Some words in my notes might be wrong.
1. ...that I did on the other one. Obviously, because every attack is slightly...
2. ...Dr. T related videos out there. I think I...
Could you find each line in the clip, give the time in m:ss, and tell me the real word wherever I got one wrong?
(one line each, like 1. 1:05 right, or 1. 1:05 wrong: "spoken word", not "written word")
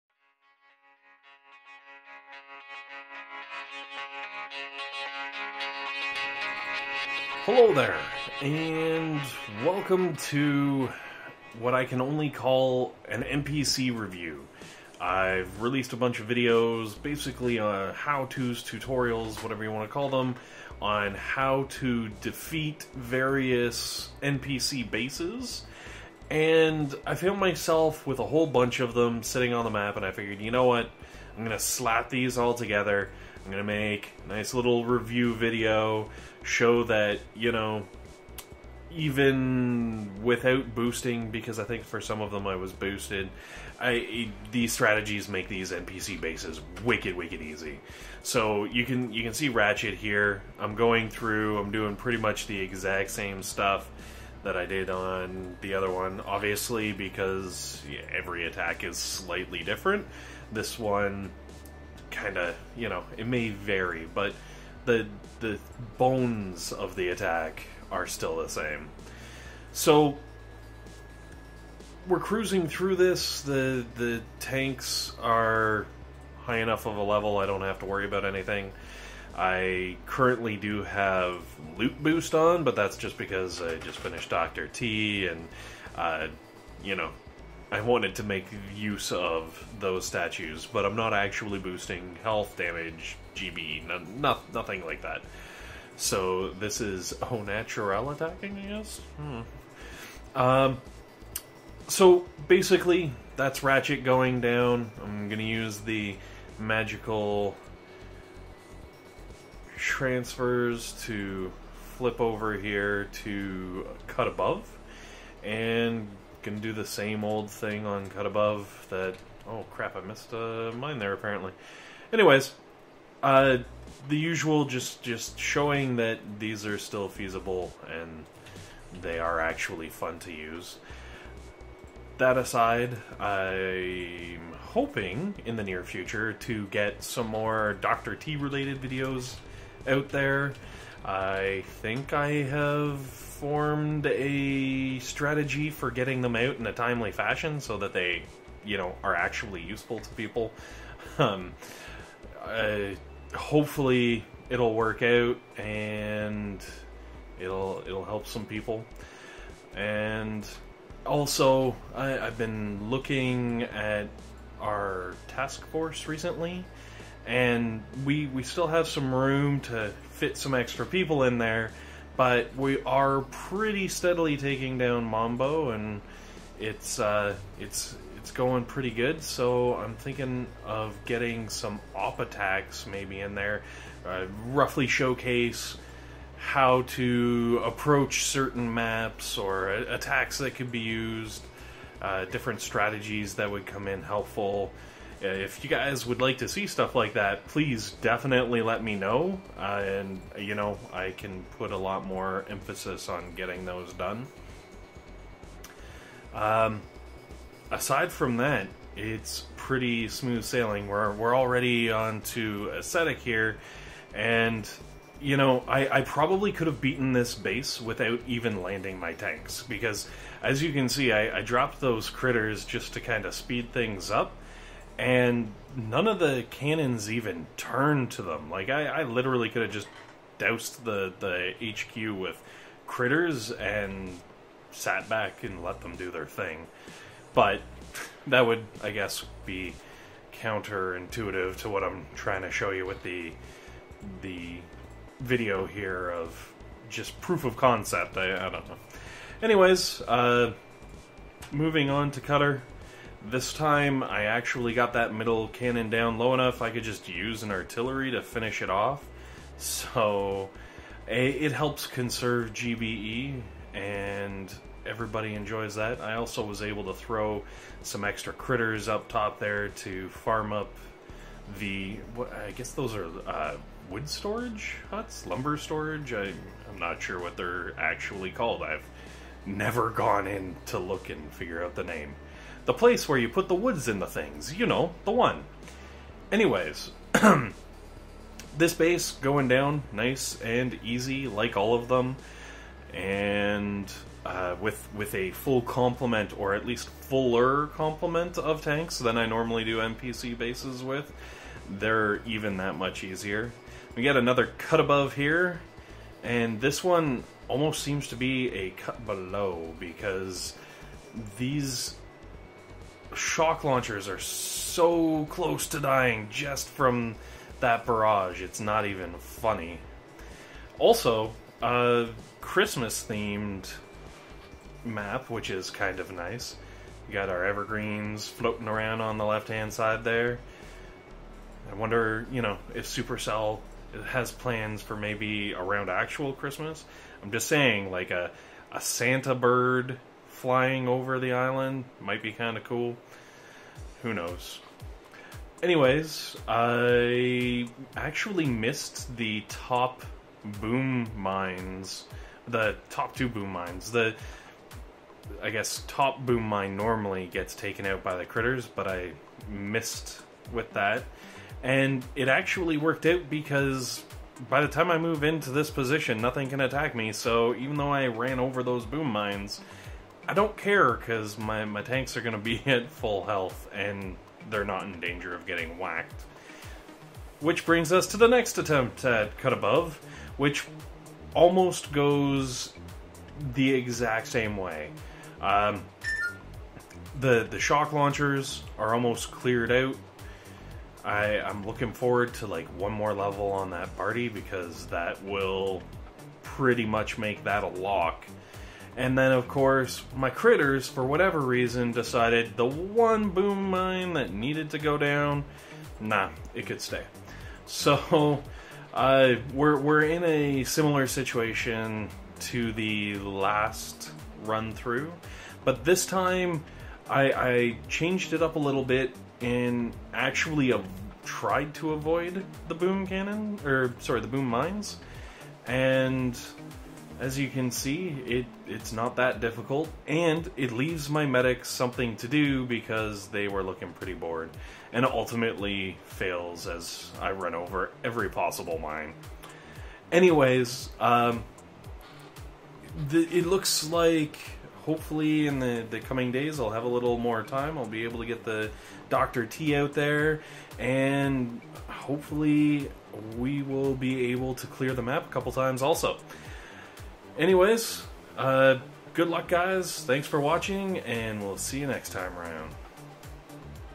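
1. 0:54 right
2. 2:17 right.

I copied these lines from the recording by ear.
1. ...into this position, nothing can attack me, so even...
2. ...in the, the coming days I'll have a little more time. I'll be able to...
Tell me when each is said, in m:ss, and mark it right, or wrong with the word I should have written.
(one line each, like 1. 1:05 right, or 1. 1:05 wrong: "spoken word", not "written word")
1. 6:05 right
2. 7:25 right.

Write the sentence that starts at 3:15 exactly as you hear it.
Uh, if you guys would like to see stuff like that, please definitely let me know.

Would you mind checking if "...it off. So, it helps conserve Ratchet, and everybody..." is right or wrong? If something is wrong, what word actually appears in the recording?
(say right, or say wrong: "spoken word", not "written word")
wrong: "GBE", not "Ratchet".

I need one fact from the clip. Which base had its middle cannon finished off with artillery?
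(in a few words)
Cutter.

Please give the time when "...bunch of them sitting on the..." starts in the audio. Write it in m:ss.
0:28.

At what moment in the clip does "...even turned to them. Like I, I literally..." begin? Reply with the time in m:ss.
3:47.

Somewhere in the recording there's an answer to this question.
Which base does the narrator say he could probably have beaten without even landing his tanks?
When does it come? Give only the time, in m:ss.
3:32.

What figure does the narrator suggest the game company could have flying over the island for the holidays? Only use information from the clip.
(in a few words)
A Santa bird.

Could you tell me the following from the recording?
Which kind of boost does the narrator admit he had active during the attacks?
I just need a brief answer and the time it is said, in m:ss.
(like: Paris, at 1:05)
Loot boost, at 1:21.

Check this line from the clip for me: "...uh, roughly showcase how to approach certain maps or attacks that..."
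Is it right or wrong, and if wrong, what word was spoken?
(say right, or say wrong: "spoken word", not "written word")
right.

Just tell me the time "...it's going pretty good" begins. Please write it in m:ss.
2:58.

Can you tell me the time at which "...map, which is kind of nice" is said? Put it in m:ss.
5:24.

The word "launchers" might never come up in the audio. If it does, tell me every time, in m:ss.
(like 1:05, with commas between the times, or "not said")
5:13, 6:27.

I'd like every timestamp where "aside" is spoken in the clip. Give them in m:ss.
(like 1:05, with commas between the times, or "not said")
2:12, 3:27.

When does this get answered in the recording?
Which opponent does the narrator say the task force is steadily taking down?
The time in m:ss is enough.
2:55.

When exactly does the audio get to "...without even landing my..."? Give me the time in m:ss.
3:37.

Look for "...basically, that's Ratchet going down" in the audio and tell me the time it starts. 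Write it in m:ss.
1:42.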